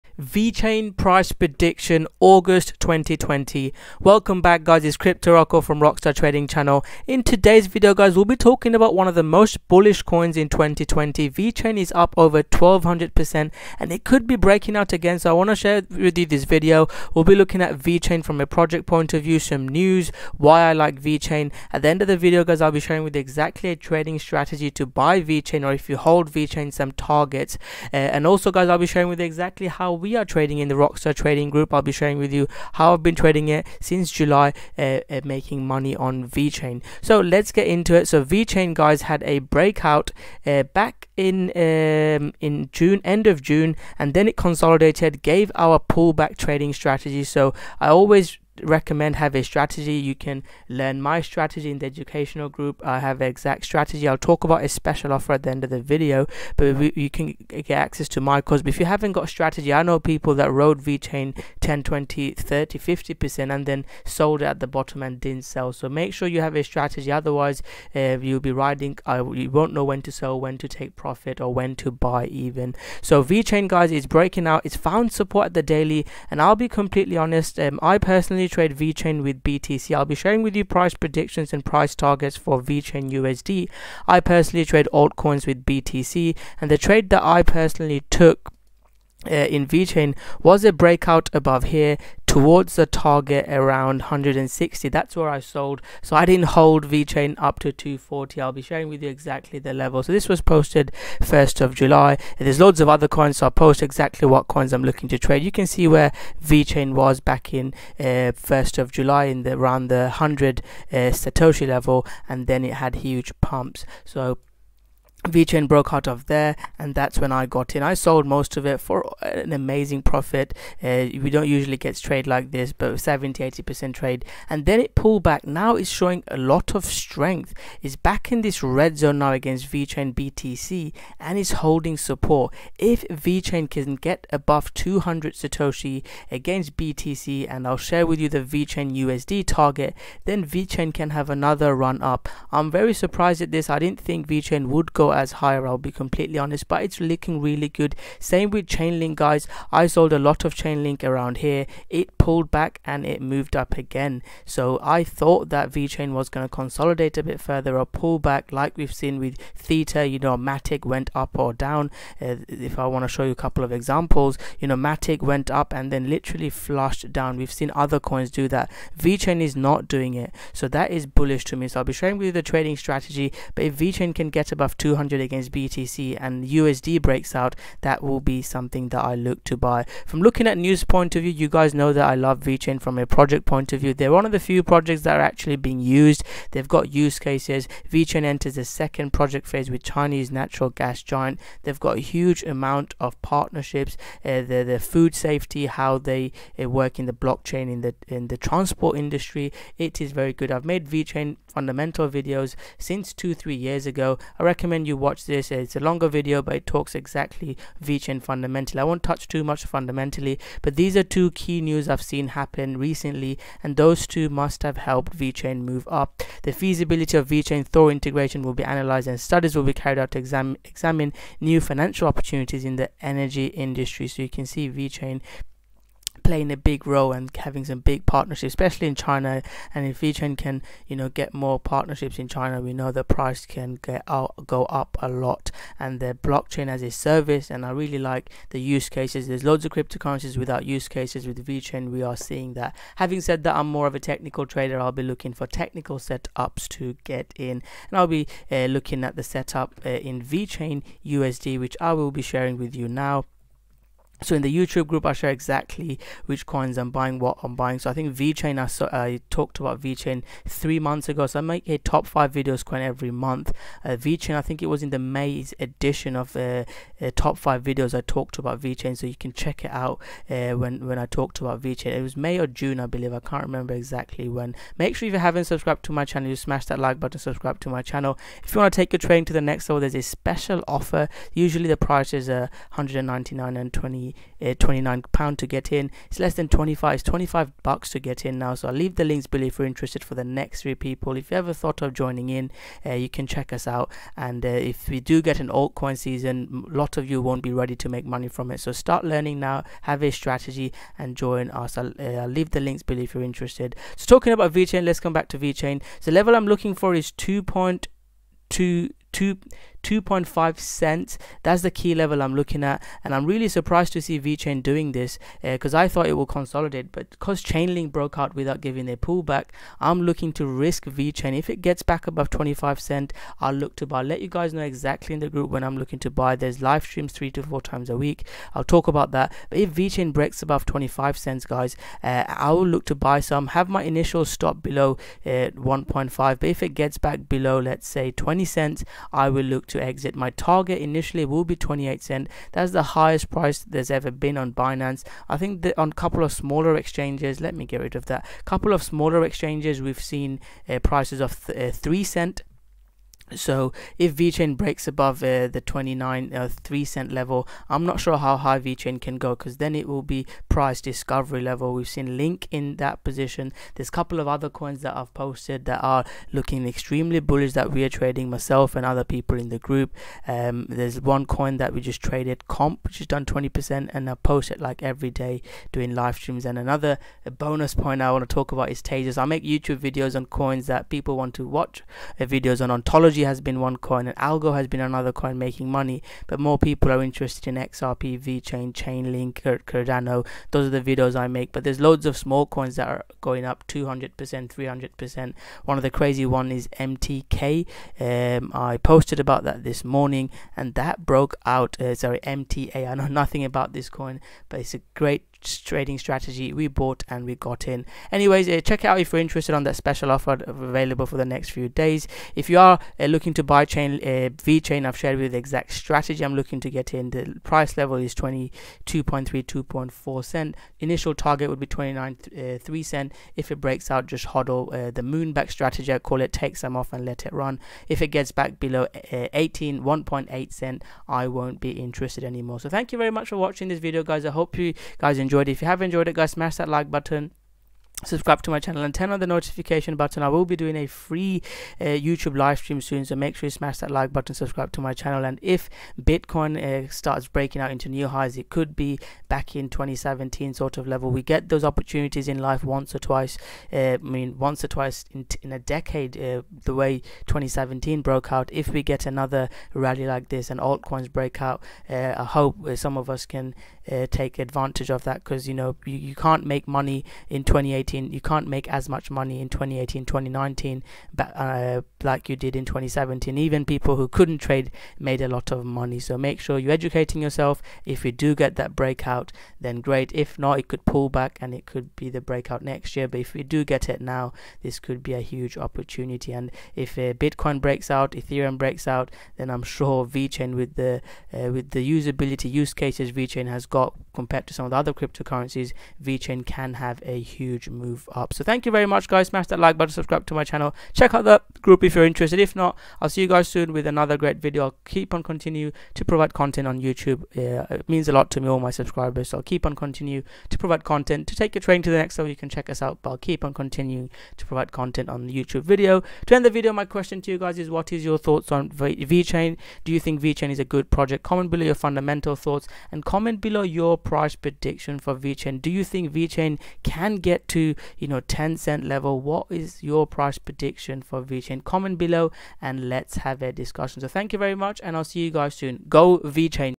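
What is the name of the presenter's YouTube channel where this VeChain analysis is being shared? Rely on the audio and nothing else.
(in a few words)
Rockstar Trading Channel.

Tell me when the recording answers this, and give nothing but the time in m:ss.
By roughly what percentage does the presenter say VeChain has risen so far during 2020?
0:12.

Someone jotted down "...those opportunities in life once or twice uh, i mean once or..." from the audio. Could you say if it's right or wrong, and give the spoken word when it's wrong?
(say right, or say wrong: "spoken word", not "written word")
right.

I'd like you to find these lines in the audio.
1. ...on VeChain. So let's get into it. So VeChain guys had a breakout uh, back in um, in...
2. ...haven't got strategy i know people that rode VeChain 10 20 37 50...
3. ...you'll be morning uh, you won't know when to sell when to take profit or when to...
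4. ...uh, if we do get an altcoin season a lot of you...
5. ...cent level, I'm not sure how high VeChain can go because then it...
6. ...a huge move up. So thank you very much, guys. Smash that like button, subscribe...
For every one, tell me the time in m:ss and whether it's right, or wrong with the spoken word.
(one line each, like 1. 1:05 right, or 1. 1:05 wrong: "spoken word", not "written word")
1. 0:35 right
2. 0:58 wrong: "30", not "37"
3. 1:08 wrong: "riding", not "morning"
4. 4:54 right
5. 5:56 right
6. 8:17 right.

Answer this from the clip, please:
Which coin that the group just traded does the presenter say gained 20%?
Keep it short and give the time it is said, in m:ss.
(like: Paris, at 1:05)
Comp, at 6:12.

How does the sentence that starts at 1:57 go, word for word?
I sold most of it for an amazing profit.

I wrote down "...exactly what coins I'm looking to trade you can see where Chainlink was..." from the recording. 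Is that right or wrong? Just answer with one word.
wrong.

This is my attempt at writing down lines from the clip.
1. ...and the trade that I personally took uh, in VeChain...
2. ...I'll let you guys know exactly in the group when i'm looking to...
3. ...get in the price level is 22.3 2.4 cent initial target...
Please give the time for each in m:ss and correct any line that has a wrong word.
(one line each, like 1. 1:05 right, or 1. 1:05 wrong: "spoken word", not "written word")
1. 1:26 right
2. 5:24 right
3. 6:56 right.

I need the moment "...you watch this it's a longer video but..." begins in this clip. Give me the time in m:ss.
3:24.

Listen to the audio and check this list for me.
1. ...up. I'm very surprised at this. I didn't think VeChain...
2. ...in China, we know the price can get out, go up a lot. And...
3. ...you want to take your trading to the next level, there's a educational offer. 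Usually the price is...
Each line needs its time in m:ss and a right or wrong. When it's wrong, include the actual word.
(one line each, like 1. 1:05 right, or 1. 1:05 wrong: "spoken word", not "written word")
1. 2:22 right
2. 3:52 right
3. 4:38 wrong: "special", not "educational".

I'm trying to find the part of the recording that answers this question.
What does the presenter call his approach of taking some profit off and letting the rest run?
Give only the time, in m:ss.
7:04.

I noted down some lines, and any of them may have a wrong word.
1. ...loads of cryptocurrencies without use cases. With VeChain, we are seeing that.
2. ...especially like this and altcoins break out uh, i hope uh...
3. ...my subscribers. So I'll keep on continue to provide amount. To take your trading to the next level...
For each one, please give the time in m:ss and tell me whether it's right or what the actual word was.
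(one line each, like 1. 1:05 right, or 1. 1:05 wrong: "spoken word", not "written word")
1. 3:59 right
2. 7:39 wrong: "rally", not "especially"
3. 8:28 wrong: "content", not "amount".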